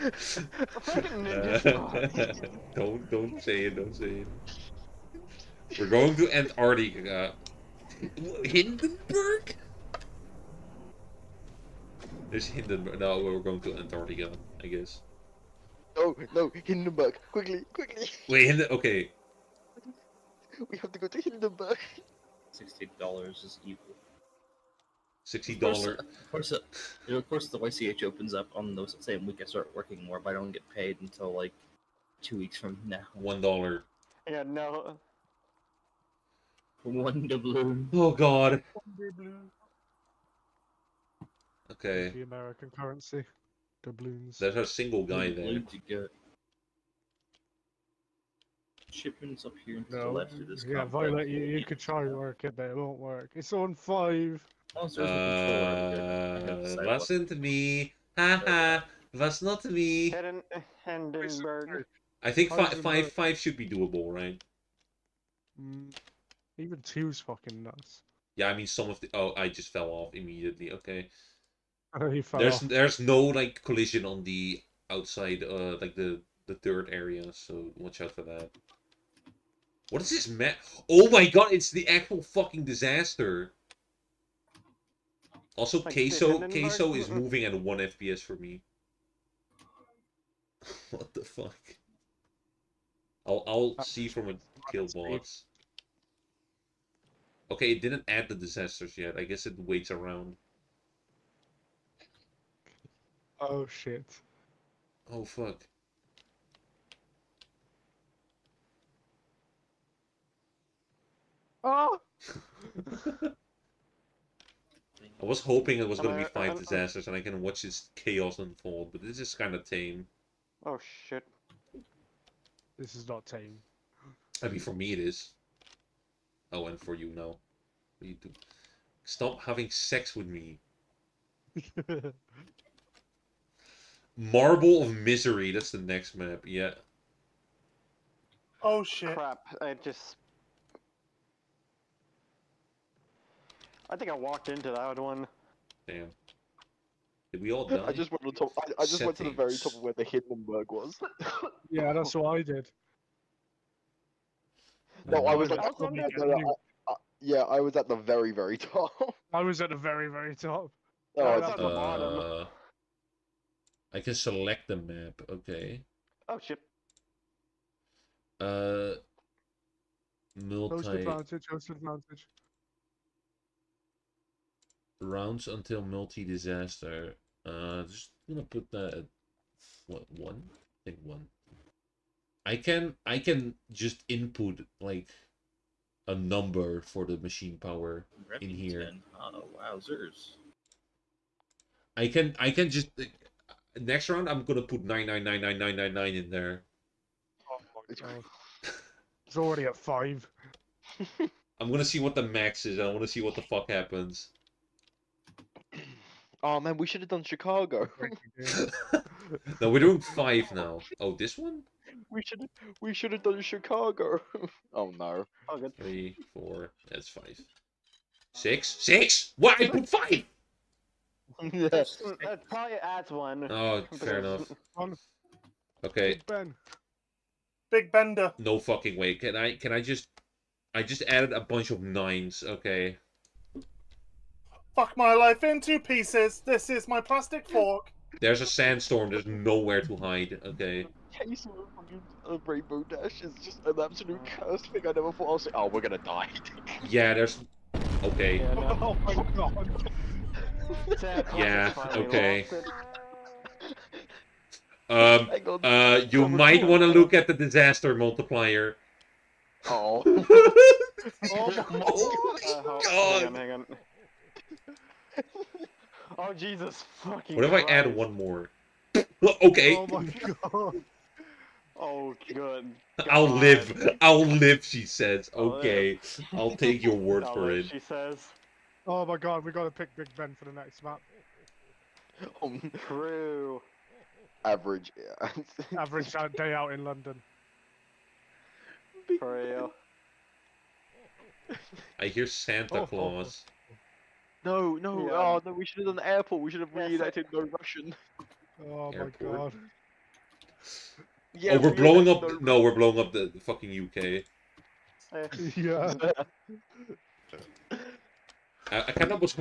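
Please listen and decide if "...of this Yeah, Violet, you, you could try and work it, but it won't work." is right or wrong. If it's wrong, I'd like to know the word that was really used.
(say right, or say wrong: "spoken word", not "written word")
right.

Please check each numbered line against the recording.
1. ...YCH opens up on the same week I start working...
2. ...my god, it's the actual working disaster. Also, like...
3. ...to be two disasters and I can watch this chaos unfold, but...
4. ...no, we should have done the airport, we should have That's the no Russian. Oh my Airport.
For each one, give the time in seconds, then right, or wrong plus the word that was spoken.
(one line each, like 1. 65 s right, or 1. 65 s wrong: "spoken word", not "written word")
1. 27 s right
2. 81 s wrong: "fucking", not "working"
3. 116 s wrong: "five", not "two"
4. 295 s right.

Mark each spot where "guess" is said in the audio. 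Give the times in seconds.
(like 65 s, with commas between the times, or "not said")
14 s, 99 s.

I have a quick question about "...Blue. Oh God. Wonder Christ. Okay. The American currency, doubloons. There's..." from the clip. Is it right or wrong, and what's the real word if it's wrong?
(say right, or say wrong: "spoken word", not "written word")
wrong: "Blue", not "Christ".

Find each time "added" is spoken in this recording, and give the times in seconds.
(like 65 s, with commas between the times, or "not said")
231 s.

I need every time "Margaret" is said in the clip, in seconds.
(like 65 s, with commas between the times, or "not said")
not said.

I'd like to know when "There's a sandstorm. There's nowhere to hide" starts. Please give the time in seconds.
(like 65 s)
238 s.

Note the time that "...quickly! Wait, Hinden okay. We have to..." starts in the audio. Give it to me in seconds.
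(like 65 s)
17 s.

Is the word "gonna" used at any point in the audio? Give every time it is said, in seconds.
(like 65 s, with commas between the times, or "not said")
178 s, 194 s, 201 s, 245 s.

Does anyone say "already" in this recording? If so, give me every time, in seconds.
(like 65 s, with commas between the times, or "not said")
199 s.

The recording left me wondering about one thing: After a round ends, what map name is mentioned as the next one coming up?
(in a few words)
Marble of Misery.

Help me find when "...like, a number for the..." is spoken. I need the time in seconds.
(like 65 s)
184 s.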